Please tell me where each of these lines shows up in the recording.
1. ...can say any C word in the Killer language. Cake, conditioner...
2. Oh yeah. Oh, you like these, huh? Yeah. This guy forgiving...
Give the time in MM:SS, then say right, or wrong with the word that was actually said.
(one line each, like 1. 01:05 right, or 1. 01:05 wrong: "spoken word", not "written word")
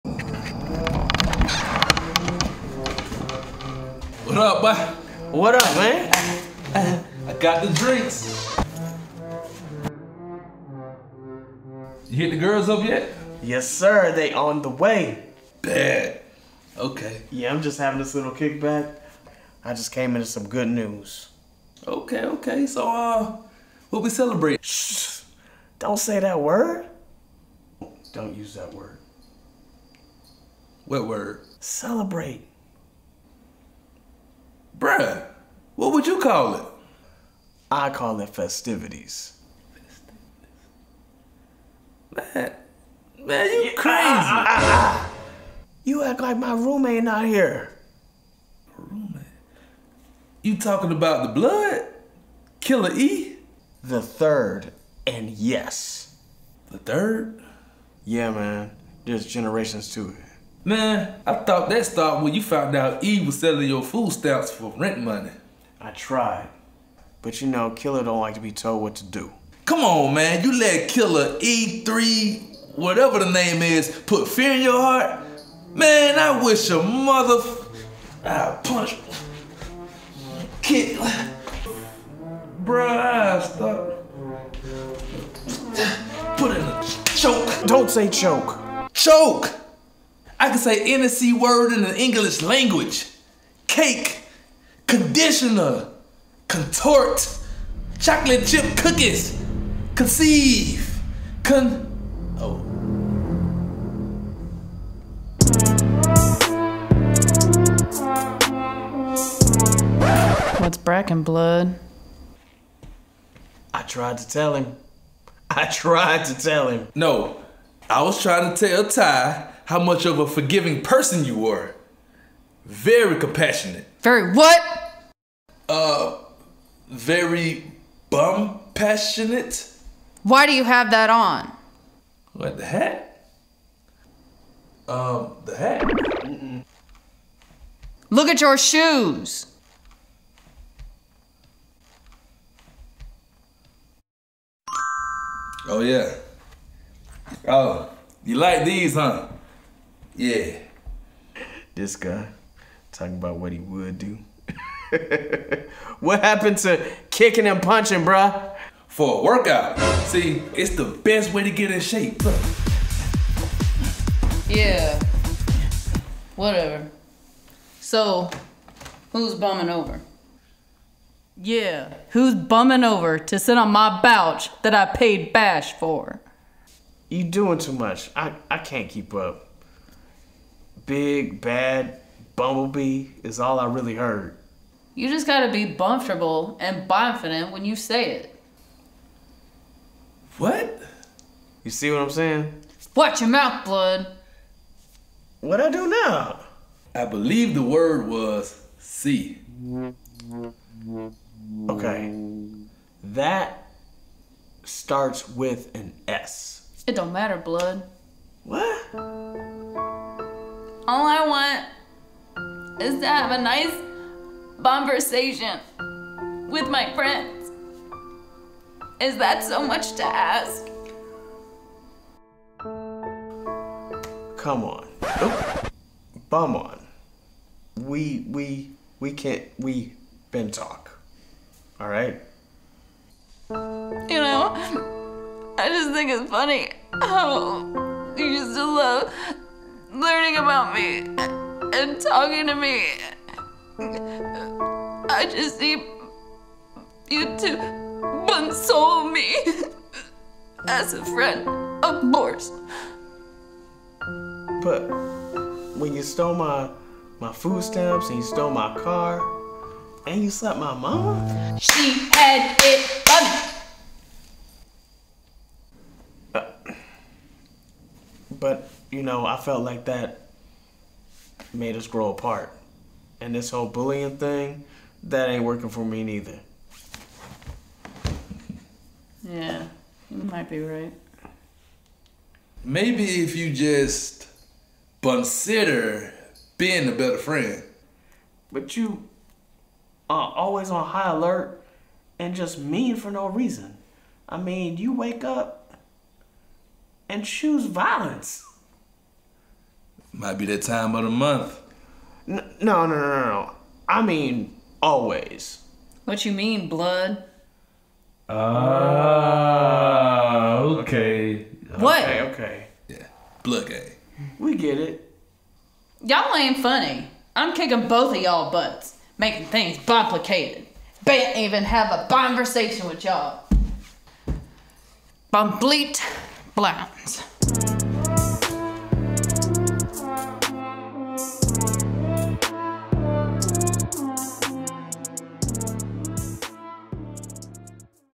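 1. 01:30 wrong: "English", not "Killer"
2. 02:25 wrong: "talking", not "forgiving".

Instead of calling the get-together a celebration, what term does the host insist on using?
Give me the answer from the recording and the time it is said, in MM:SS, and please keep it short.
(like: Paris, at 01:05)
festivities, at 00:38.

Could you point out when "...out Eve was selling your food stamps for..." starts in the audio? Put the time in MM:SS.
01:02.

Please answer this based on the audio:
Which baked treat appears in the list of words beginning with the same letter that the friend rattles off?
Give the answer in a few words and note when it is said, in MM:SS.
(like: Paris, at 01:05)
chocolate chip cookies, at 01:37.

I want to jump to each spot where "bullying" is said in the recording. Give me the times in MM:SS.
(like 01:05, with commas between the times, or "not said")
04:33.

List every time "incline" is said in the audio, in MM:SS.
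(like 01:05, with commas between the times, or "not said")
not said.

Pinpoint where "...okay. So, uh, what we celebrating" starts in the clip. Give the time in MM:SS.
00:22.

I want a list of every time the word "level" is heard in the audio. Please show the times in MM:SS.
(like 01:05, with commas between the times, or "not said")
not said.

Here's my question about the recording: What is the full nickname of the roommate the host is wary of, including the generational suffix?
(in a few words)
Killer E the third.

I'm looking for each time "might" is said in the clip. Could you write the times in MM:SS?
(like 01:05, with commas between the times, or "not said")
04:40, 05:00.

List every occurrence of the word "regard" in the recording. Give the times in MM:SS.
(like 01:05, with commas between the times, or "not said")
not said.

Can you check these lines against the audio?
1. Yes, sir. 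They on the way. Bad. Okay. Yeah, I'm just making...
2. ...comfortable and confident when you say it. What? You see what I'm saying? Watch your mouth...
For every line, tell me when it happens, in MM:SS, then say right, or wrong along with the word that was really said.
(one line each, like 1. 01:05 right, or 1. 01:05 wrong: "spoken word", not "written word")
1. 00:13 wrong: "having", not "making"
2. 03:05 right.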